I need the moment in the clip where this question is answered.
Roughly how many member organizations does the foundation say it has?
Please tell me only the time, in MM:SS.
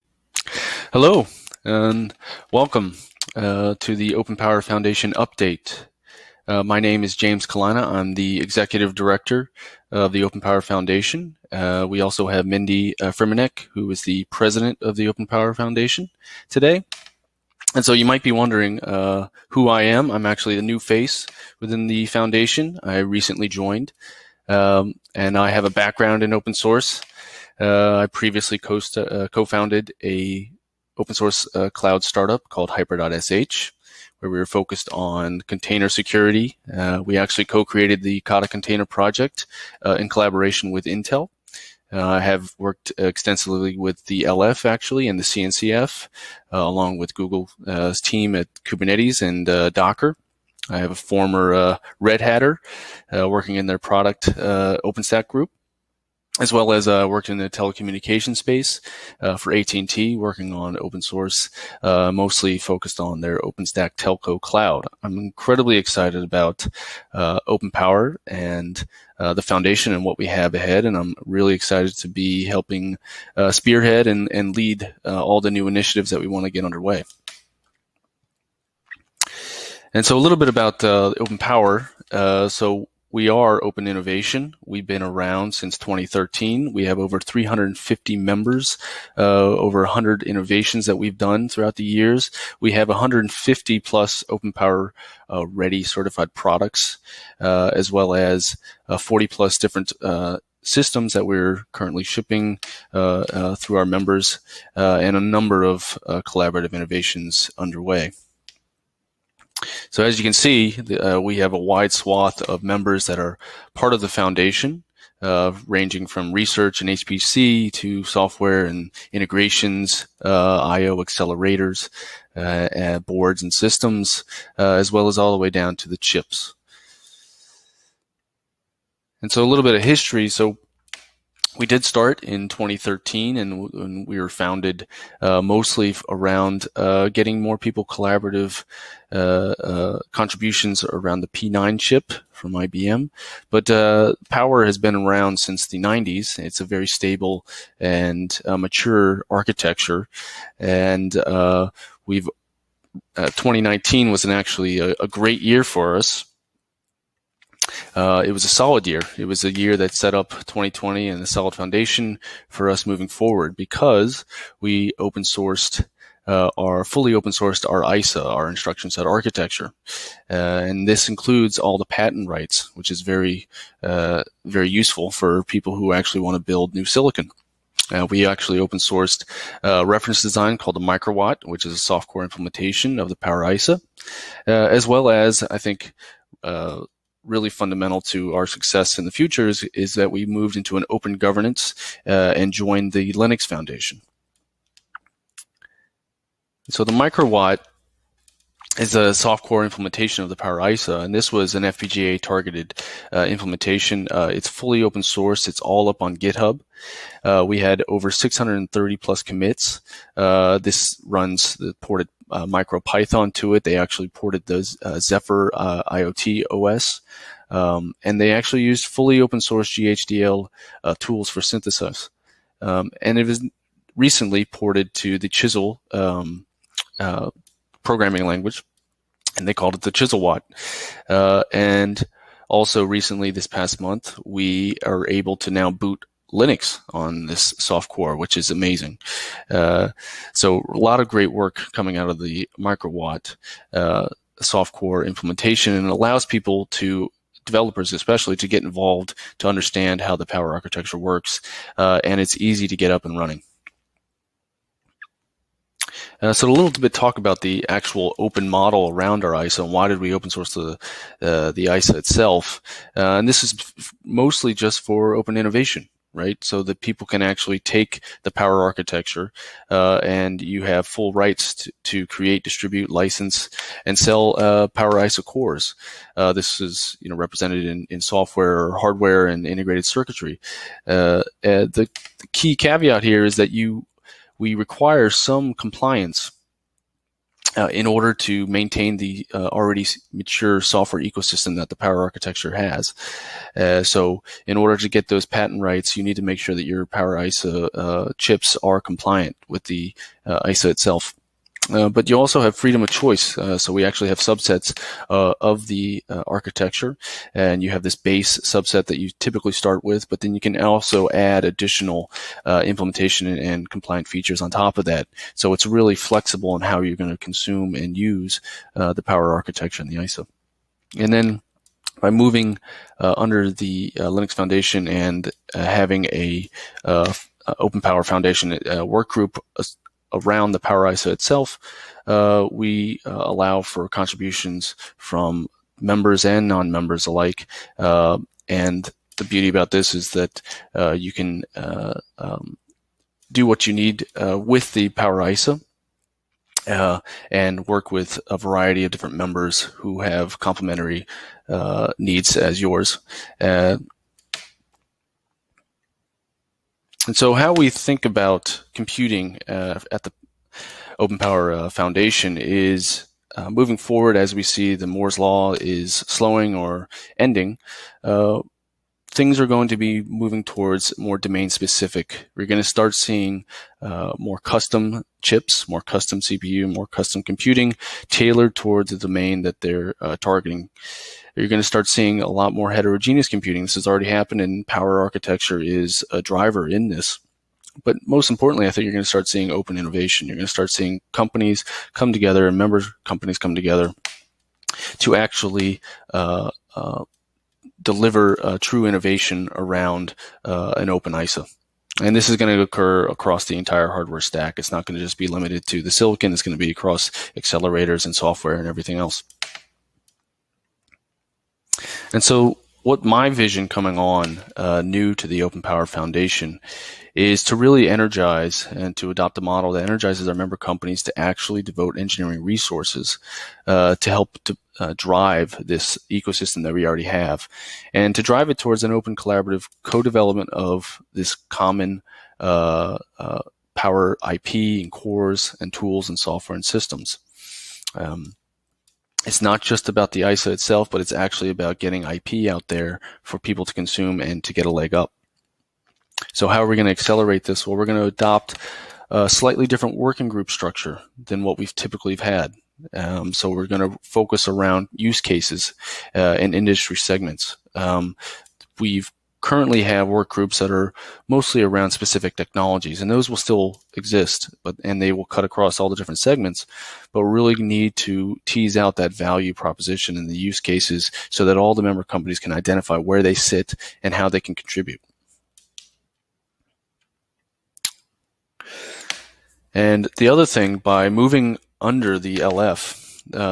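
01:26.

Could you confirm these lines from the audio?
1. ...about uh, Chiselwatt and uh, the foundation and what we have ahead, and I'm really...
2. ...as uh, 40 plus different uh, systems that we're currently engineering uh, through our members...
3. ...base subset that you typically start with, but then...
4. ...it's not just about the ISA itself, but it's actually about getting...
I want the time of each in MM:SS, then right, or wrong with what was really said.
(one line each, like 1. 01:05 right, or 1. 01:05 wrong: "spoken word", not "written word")
1. 01:06 wrong: "OpenPower", not "Chiselwatt"
2. 01:38 wrong: "shipping", not "engineering"
3. 05:07 right
4. 07:19 right.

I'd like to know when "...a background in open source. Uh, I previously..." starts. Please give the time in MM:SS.
00:25.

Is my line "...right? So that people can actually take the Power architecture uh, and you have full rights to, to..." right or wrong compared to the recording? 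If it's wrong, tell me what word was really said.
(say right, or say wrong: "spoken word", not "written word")
right.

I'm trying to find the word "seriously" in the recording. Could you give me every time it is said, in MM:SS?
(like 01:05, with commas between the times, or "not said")
not said.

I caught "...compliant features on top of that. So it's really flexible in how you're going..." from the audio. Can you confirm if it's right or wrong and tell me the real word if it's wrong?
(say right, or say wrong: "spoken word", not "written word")
right.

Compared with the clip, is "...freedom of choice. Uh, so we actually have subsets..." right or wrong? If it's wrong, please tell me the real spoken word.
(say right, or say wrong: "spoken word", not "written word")
right.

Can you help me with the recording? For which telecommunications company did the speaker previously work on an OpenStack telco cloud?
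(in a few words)
AT&T.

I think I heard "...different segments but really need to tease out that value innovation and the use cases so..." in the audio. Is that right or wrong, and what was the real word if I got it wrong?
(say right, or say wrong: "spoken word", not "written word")
wrong: "proposition", not "innovation".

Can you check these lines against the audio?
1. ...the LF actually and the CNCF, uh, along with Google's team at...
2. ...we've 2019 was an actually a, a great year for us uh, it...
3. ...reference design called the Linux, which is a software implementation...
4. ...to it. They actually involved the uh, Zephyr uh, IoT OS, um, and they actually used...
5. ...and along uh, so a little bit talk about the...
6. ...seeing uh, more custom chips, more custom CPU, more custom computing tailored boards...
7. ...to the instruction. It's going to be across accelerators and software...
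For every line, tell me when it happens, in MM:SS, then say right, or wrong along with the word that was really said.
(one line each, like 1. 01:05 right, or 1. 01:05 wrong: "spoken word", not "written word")
1. 00:44 right
2. 02:32 right
3. 02:59 wrong: "Microwatt", not "Linux"
4. 03:33 wrong: "ported", not "involved"
5. 04:13 wrong: "running", not "along"
6. 06:12 wrong: "towards", not "boards"
7. 06:45 wrong: "silicon", not "instruction".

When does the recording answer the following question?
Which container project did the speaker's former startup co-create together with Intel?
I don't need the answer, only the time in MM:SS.
00:38.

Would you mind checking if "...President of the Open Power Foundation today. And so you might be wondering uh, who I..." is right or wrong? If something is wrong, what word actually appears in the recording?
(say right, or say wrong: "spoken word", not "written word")
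right.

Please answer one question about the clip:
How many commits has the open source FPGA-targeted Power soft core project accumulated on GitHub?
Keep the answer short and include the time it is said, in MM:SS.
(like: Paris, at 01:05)
630+, at 03:28.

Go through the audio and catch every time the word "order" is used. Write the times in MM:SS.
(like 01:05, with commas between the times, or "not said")
04:47, 04:54.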